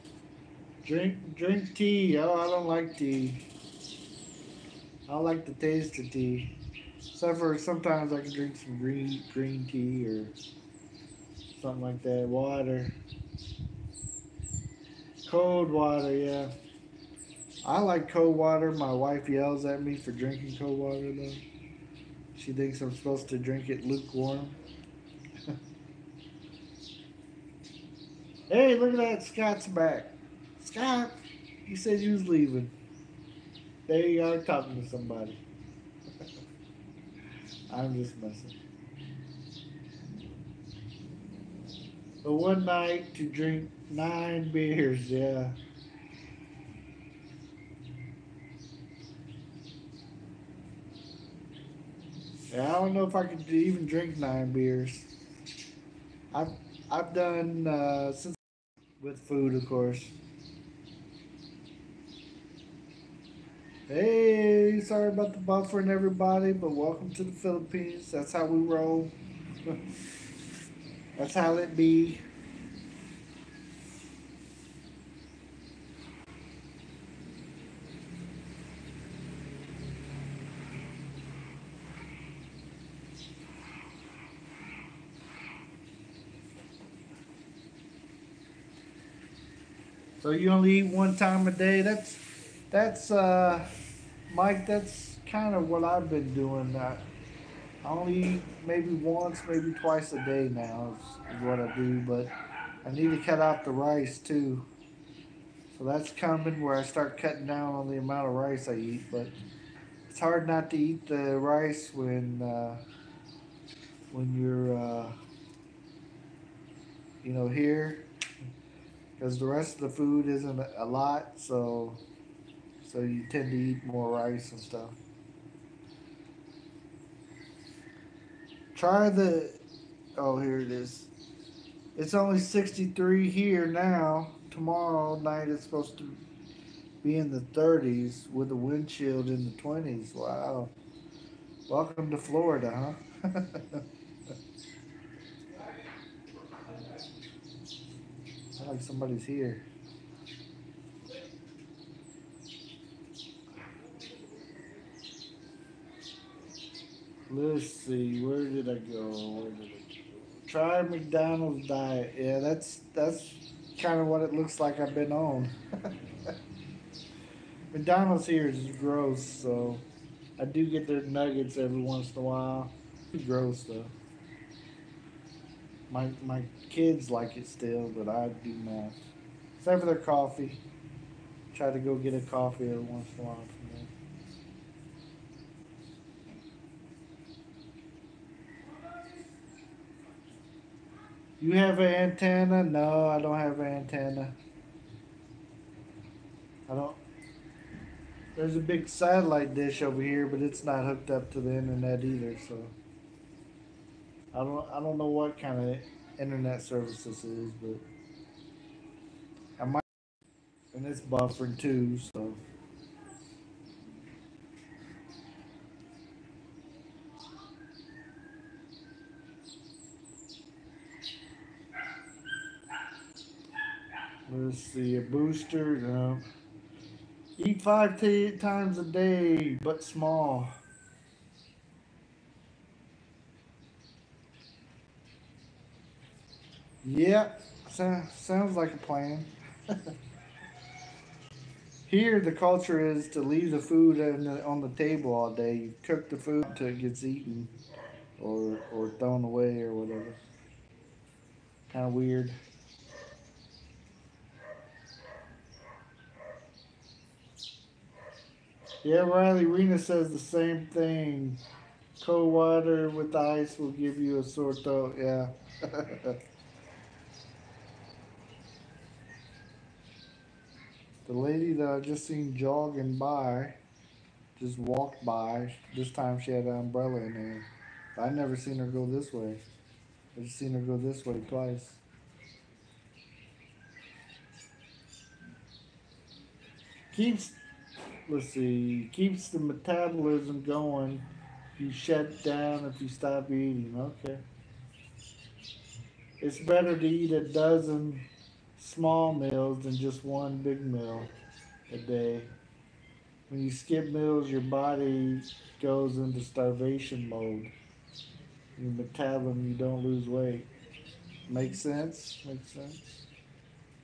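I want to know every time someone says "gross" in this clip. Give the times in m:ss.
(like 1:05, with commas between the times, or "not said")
2:48, 2:53.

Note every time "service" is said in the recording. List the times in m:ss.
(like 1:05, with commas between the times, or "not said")
3:26.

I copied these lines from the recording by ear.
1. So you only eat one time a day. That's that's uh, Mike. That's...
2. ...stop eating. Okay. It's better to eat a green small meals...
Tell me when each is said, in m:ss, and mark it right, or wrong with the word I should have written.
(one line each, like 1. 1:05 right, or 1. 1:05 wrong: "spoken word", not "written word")
1. 1:30 right
2. 4:52 wrong: "dozen", not "green".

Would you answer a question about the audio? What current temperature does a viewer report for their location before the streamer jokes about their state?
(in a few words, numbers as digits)
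63.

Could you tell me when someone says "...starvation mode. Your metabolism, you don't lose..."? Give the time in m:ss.
5:06.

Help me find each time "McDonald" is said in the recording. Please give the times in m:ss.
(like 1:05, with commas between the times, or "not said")
2:40, 2:47.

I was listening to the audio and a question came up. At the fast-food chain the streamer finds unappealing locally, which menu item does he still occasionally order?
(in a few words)
nuggets.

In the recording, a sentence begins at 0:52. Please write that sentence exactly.
Yeah, I don't know if I could even drink nine beers.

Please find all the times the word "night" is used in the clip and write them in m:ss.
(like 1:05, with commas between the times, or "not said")
0:42, 2:15.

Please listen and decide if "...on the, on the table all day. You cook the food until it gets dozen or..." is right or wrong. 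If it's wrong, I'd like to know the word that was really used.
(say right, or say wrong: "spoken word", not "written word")
wrong: "eaten", not "dozen".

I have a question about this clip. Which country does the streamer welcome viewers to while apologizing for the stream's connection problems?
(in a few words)
the Philippines.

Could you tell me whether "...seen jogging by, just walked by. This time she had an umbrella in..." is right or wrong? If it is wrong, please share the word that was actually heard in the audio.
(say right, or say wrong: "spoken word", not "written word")
right.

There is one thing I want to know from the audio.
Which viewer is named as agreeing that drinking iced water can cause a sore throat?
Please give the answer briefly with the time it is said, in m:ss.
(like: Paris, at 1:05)
Riley Rena, at 4:19.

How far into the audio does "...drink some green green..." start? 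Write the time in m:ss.
0:08.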